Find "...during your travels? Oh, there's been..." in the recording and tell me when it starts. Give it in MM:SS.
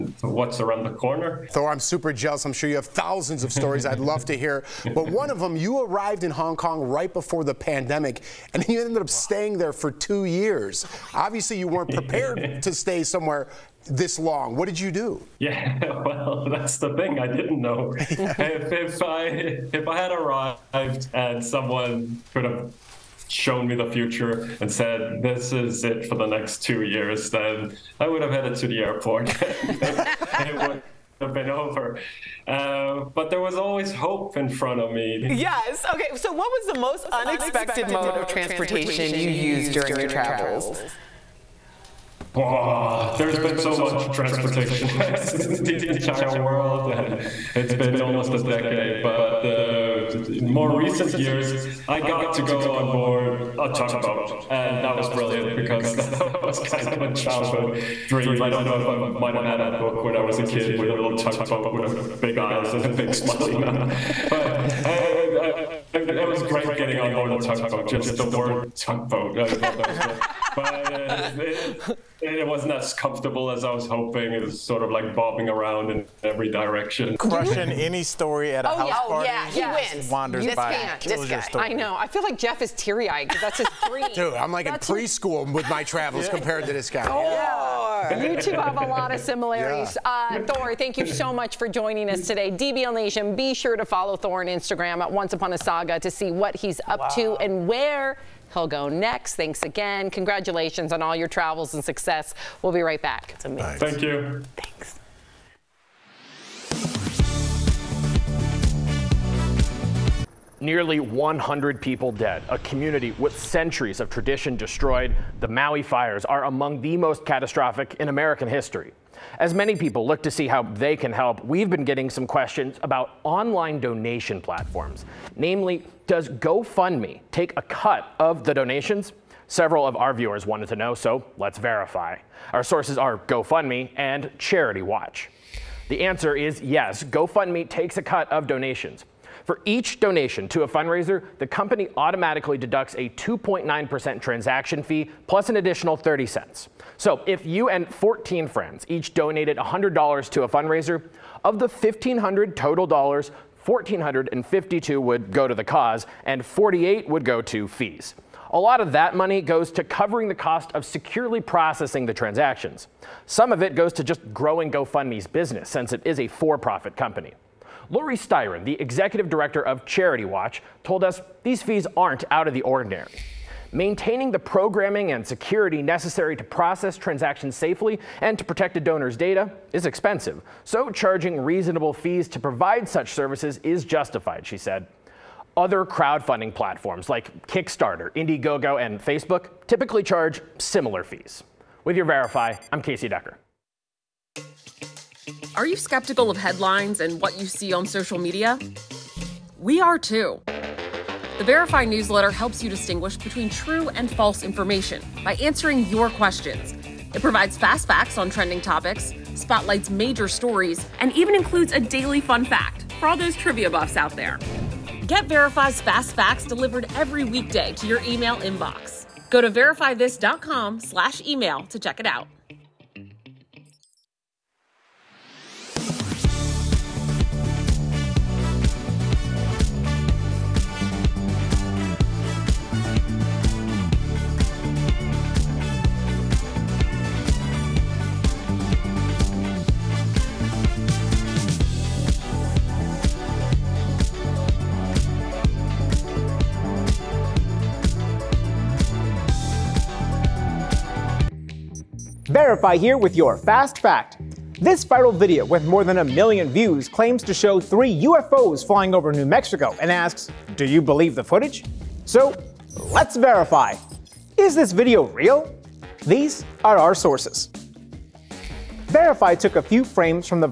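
00:39.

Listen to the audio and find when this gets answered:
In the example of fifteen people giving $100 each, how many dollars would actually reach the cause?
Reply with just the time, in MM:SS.
02:33.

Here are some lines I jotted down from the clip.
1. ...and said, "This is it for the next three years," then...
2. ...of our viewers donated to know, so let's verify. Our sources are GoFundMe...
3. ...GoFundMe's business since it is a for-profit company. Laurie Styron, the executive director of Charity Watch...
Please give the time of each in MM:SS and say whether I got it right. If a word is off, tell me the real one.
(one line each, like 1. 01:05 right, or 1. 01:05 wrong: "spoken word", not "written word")
1. 00:24 wrong: "two", not "three"
2. 02:09 wrong: "wanted", not "donated"
3. 02:44 right.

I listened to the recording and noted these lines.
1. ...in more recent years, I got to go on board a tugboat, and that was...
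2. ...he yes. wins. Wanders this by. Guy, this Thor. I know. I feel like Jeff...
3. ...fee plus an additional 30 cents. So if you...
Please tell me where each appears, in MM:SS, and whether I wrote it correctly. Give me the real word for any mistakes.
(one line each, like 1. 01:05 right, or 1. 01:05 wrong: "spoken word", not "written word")
1. 00:50 right
2. 01:19 wrong: "Story", not "Thor"
3. 02:24 right.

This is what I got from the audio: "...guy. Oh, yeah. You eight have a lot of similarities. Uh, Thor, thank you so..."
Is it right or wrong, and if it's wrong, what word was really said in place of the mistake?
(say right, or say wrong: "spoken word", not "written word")
wrong: "two", not "eight".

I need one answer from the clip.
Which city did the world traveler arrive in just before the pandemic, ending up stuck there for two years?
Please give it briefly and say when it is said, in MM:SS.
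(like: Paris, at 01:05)
Hong Kong, at 00:06.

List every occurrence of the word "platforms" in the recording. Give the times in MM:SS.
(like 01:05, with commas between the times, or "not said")
02:04, 03:06.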